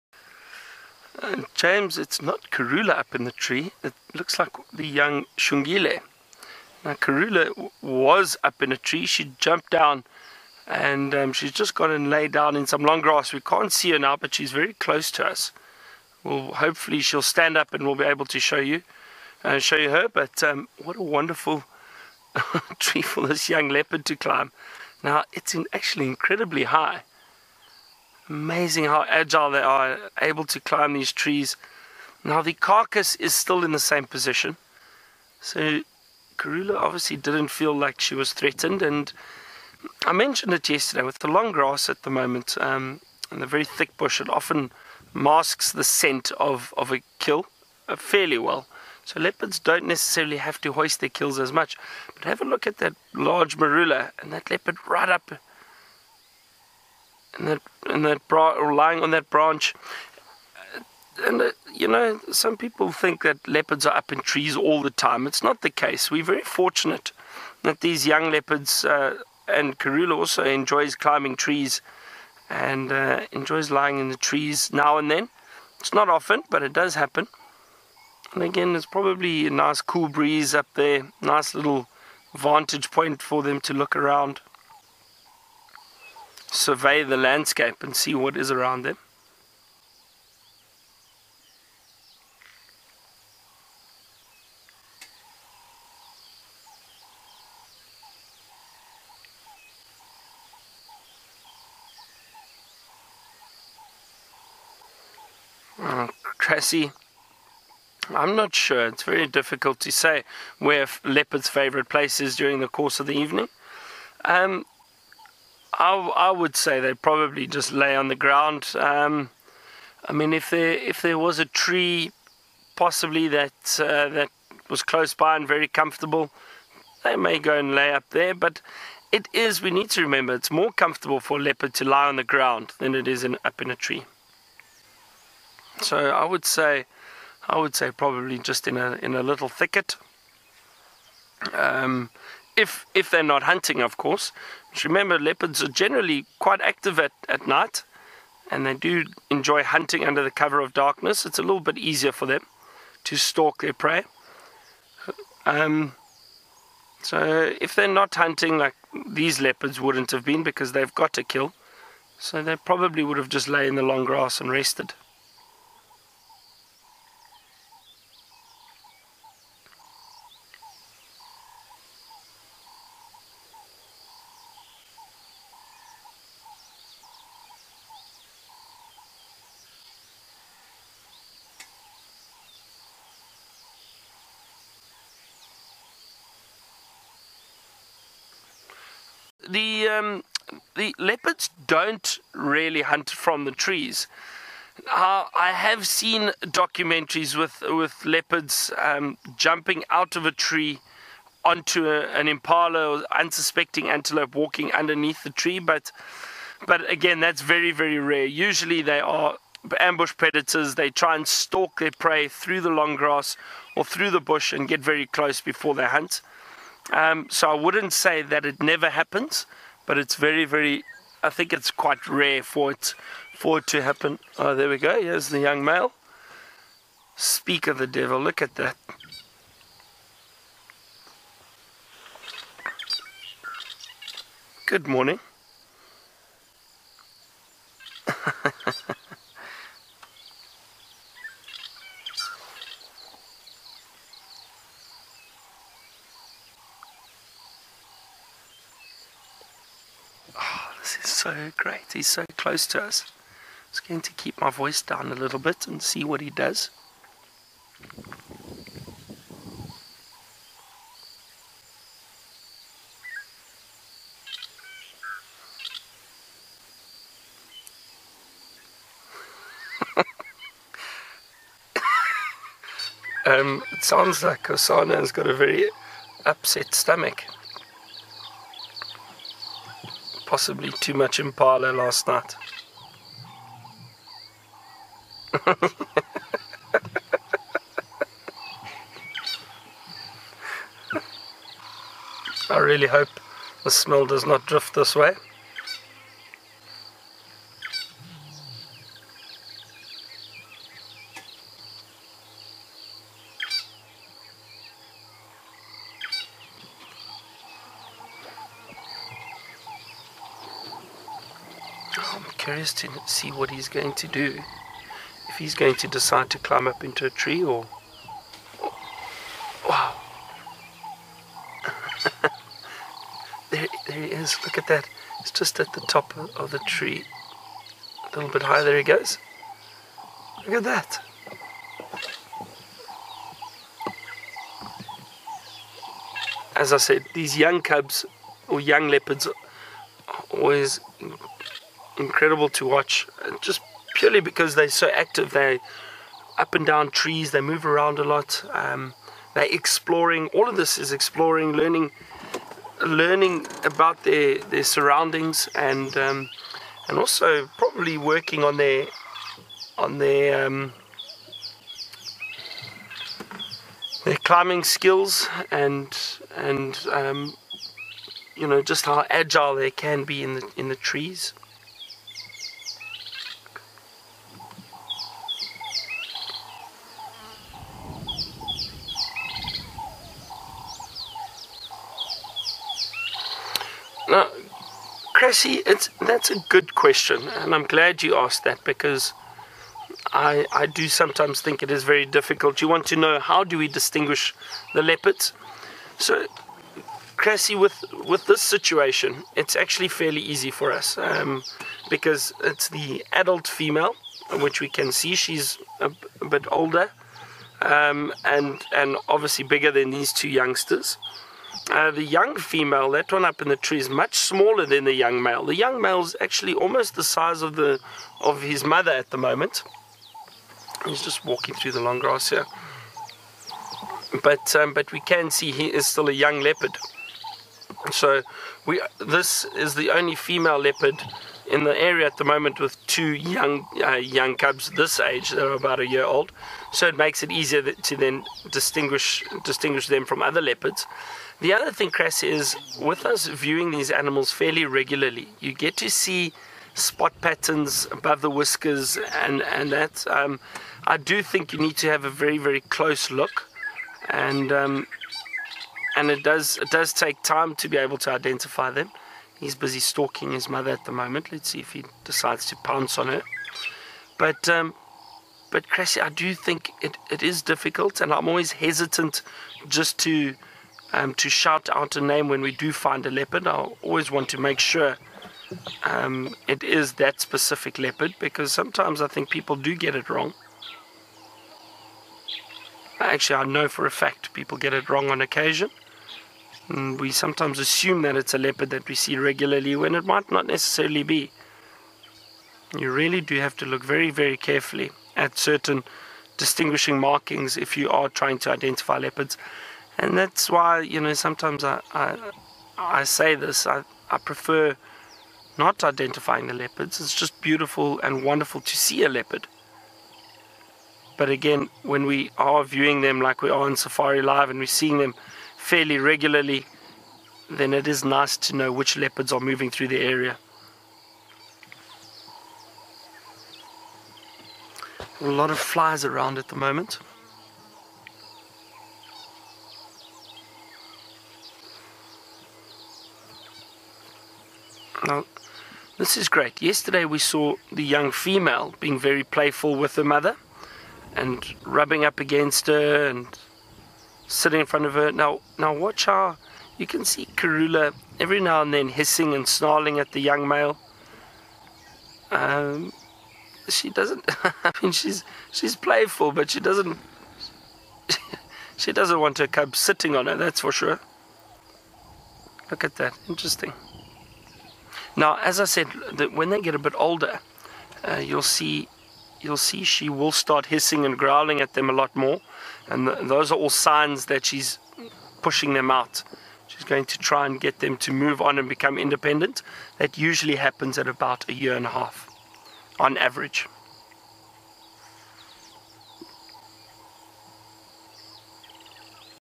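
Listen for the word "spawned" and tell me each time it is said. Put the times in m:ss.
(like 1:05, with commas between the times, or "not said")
not said.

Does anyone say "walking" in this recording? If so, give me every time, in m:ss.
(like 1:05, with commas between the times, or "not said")
3:24, 7:01.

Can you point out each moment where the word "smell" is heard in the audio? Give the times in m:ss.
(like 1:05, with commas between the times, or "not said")
4:53.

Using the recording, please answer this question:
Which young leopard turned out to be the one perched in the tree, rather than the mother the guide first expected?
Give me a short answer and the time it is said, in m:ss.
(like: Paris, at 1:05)
Xongile, at 0:04.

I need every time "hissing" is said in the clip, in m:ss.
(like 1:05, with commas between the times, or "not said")
9:08, 9:30.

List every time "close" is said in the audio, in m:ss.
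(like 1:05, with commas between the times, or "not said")
0:14, 2:04, 3:35, 4:12, 7:32.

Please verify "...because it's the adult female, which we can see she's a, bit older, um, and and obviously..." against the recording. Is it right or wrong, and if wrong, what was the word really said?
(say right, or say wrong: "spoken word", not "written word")
right.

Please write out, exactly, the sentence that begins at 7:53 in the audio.
I always want to make sure um, it is that specific leopard because sometimes I think people do get it wrong.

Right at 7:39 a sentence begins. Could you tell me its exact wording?
He's busy stalking his mother at the moment.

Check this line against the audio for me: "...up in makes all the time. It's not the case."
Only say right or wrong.
wrong.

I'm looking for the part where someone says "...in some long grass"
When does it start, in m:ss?
0:12.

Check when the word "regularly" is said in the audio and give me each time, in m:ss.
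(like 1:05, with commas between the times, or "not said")
7:24, 8:09, 8:35.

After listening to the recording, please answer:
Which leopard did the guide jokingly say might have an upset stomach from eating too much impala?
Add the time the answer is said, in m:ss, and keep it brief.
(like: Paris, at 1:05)
Hosana, at 4:34.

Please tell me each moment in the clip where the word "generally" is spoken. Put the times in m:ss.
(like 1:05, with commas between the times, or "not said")
2:25.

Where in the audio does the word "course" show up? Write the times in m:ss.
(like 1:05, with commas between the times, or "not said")
1:52, 2:23.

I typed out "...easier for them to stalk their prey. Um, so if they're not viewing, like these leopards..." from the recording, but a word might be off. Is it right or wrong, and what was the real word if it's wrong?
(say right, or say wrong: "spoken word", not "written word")
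wrong: "hunting", not "viewing".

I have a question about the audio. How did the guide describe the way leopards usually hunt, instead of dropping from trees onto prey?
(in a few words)
Ambush predators.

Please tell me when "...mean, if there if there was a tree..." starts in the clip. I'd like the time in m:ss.
2:00.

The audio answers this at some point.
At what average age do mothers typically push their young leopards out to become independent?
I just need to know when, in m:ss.
9:41.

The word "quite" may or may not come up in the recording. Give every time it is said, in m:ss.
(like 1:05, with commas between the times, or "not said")
2:26, 3:41.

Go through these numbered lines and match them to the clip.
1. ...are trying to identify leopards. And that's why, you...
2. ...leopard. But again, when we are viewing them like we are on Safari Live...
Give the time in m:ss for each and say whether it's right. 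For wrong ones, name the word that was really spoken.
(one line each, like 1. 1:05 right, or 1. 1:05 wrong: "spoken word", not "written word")
1. 8:17 right
2. 8:29 right.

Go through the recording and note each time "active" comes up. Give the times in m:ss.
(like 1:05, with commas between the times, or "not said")
2:26, 5:44.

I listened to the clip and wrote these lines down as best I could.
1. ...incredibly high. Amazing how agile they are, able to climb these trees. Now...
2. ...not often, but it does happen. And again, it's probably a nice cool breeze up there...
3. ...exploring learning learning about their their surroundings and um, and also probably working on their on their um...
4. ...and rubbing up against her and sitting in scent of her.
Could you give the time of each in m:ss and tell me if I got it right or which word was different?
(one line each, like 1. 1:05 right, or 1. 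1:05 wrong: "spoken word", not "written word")
1. 0:26 right
2. 1:15 right
3. 5:50 right
4. 9:01 wrong: "front", not "scent".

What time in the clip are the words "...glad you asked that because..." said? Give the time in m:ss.
6:27.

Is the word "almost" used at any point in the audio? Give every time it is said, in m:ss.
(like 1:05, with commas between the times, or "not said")
6:56.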